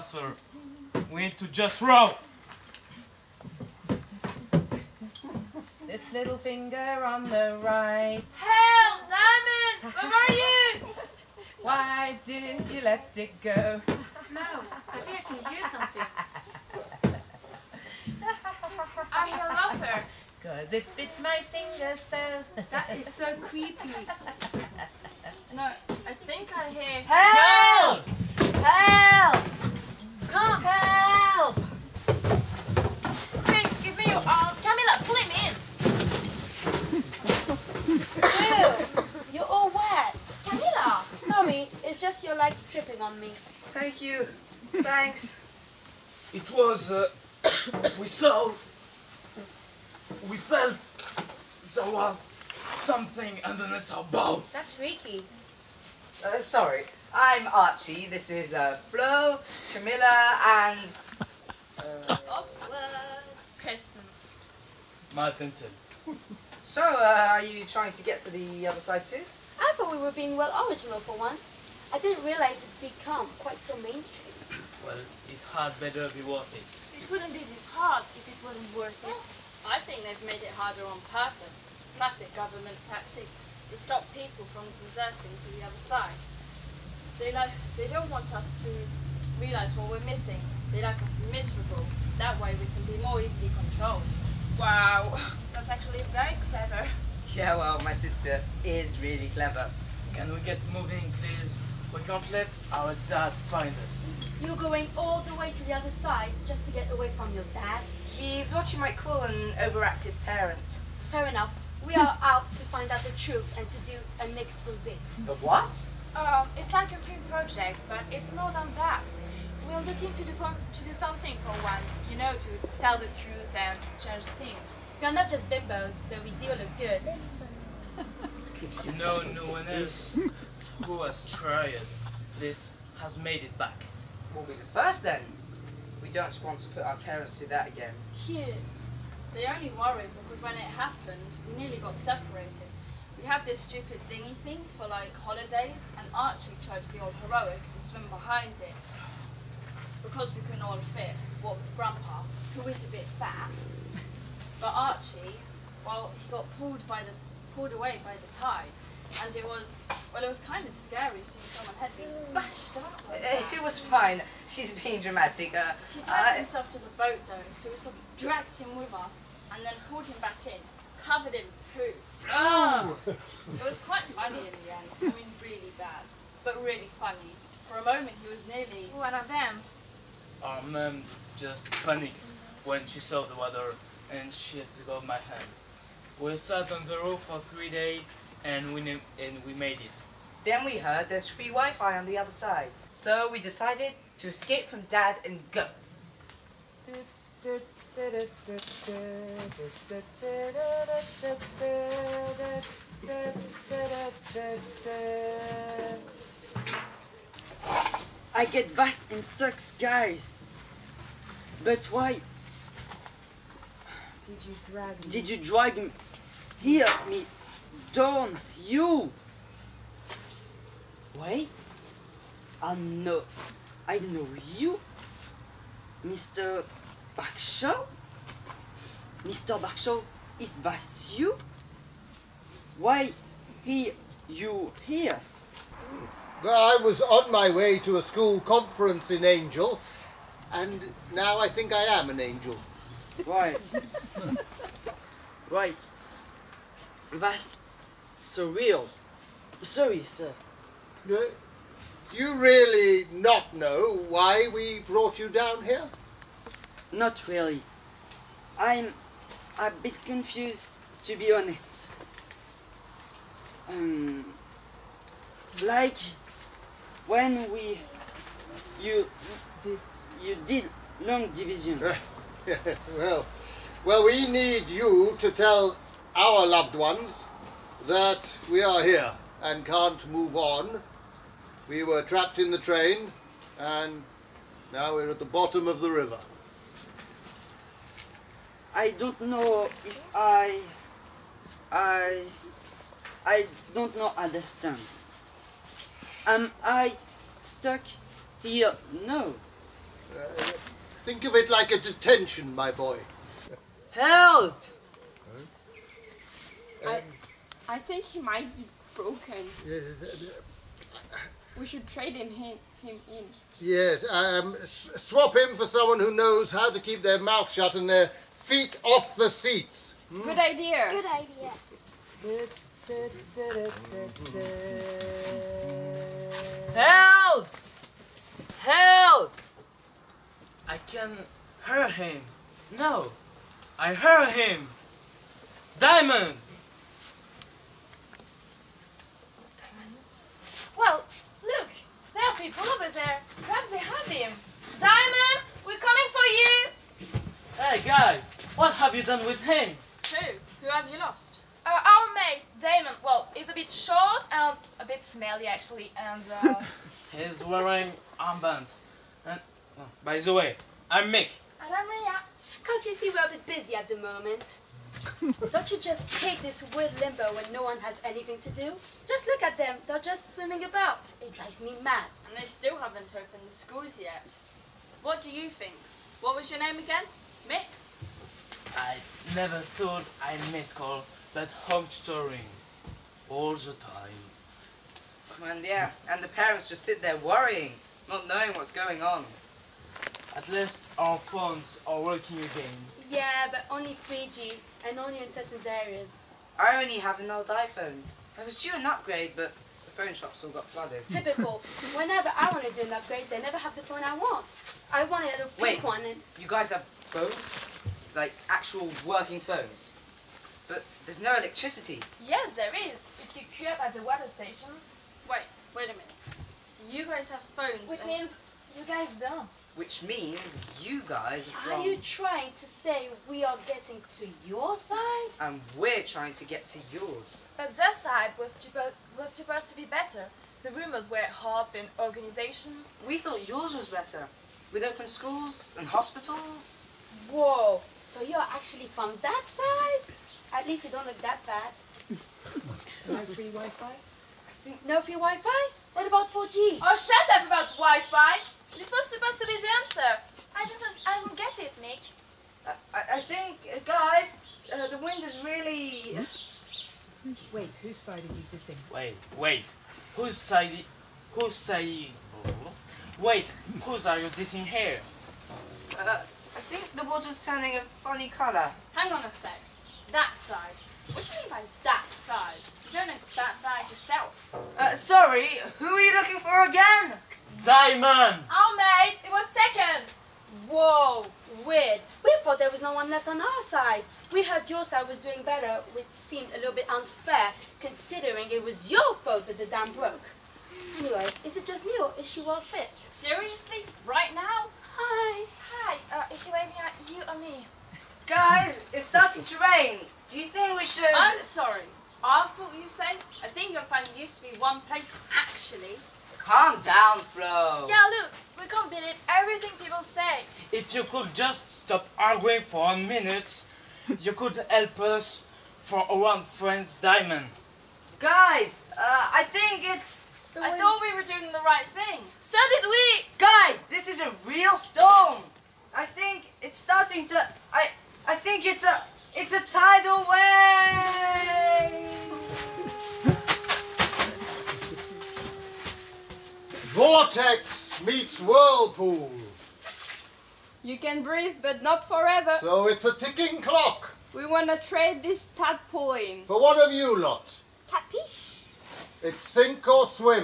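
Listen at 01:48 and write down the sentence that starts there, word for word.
He's what you might call an overactive parent.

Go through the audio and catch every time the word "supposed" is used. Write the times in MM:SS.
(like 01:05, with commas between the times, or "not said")
07:09, 07:29.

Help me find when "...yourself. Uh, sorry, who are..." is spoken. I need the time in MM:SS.
07:53.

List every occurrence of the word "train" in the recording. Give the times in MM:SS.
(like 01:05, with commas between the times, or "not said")
04:42.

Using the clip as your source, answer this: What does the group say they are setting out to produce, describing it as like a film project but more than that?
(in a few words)
An expose.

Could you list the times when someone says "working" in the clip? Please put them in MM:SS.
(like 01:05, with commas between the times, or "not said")
06:32, 06:49.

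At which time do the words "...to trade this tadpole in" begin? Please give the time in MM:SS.
09:04.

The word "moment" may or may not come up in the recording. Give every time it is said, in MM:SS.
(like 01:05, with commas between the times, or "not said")
02:57, 06:03.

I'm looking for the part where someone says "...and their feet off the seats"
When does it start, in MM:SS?
05:17.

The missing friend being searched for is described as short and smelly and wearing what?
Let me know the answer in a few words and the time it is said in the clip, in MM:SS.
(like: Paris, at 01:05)
Armbands, at 05:58.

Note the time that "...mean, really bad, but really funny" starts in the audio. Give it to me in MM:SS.
02:55.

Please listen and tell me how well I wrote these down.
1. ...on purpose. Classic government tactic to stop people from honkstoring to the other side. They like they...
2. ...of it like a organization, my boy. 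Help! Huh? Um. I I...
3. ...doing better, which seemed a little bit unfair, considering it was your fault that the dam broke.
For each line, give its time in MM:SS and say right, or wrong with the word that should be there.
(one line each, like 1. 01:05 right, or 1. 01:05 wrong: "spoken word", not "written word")
1. 01:20 wrong: "deserting", not "honkstoring"
2. 05:01 wrong: "detention", not "organization"
3. 08:05 right.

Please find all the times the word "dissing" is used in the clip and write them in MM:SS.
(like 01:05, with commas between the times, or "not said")
07:38, 07:44.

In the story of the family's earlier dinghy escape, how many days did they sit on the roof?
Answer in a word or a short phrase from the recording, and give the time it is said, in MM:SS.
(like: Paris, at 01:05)
3 days, at 03:07.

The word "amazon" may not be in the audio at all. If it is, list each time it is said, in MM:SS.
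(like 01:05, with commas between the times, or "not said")
not said.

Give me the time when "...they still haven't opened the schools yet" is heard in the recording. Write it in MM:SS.
06:12.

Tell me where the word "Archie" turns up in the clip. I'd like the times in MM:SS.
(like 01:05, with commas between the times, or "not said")
00:57, 02:26, 02:34.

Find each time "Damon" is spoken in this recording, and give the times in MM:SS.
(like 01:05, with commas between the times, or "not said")
05:52.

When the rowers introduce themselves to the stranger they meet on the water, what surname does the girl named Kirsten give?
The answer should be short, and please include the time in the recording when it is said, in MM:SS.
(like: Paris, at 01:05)
Martinson, at 01:05.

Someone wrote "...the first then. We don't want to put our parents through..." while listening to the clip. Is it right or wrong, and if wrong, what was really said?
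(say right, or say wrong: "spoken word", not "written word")
right.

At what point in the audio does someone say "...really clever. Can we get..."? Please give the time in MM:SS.
01:39.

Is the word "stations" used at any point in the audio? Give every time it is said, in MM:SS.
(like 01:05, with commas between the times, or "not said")
06:54.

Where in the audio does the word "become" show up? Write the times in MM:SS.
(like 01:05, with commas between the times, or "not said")
01:12.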